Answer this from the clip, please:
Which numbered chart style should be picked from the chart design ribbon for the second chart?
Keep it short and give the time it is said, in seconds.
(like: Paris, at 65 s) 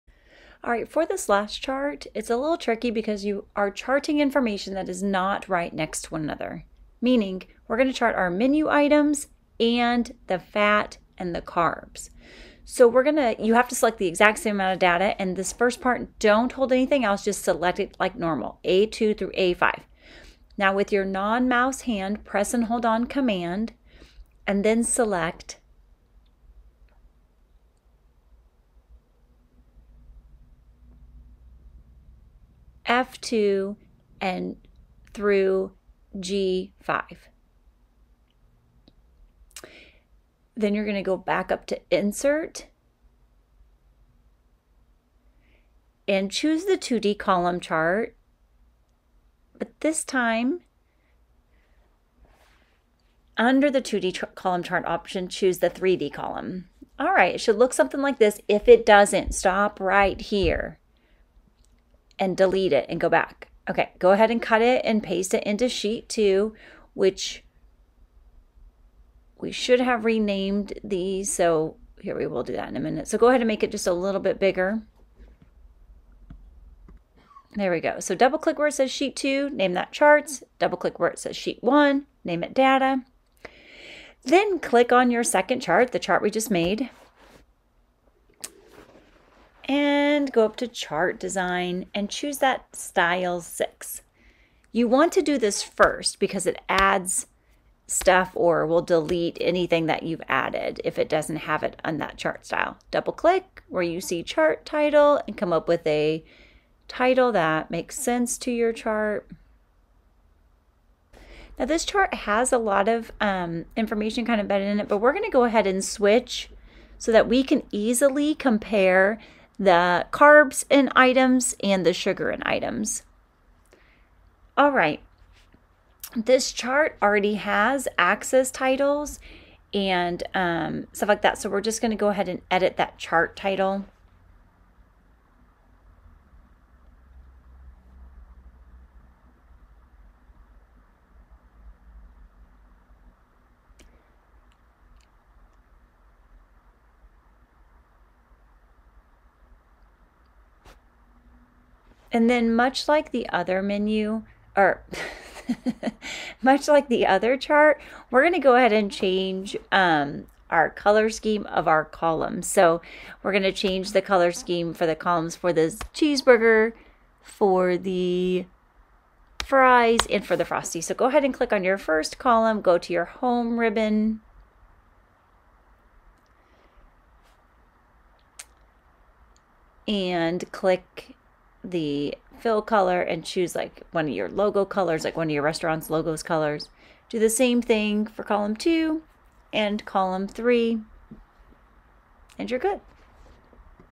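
6, at 93 s.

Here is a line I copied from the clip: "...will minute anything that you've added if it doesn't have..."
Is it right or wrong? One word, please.
wrong.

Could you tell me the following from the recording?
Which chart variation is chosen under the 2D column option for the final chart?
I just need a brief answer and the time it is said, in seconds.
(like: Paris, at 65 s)
3D column, at 55 s.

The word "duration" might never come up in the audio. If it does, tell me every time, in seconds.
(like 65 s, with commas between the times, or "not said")
not said.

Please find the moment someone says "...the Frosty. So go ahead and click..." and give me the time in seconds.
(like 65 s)
170 s.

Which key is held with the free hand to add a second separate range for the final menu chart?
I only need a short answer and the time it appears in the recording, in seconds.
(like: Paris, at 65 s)
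command, at 23 s.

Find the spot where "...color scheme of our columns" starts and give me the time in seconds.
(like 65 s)
160 s.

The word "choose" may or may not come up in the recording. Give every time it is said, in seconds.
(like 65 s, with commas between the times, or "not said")
46 s, 55 s, 92 s, 183 s.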